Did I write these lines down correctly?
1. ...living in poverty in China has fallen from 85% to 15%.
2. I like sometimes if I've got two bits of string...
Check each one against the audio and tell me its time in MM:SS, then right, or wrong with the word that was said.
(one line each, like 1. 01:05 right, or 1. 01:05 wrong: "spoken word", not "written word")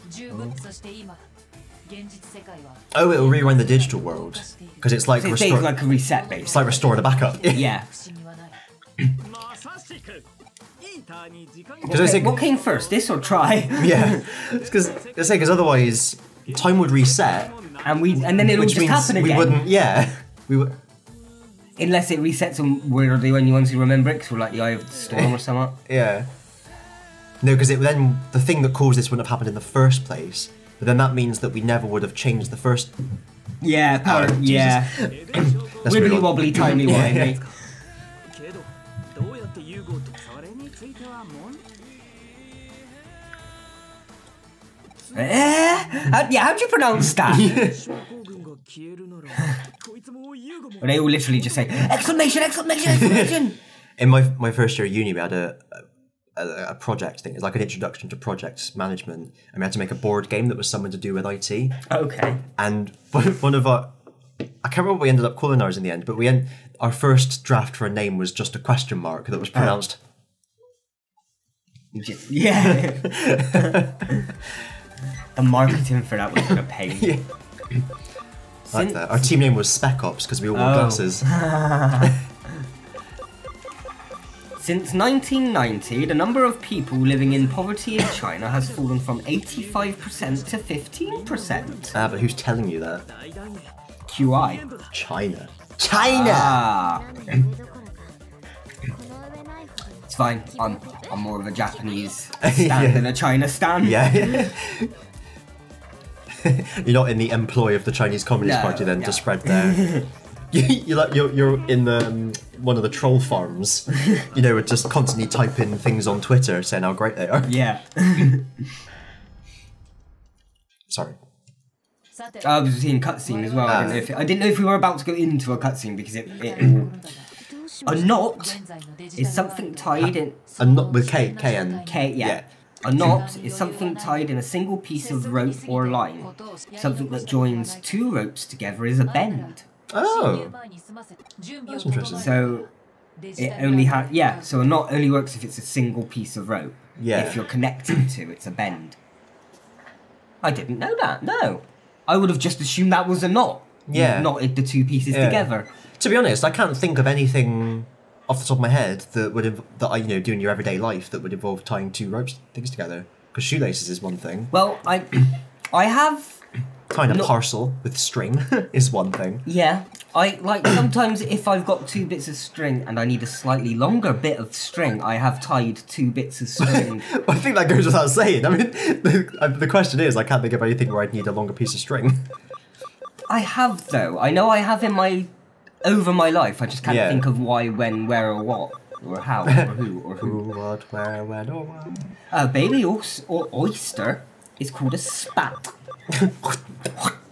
1. 01:26 right
2. 02:50 right.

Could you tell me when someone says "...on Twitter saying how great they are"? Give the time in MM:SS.
01:56.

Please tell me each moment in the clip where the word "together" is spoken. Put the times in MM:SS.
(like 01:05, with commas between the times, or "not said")
02:18, 02:35, 02:42.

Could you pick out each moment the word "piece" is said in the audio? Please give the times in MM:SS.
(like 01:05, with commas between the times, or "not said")
02:14, 02:26, 02:34, 03:01.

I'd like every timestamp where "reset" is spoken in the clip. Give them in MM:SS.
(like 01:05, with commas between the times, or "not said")
00:05, 00:16, 00:22.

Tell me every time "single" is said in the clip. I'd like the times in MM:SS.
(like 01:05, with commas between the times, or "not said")
02:14, 02:25.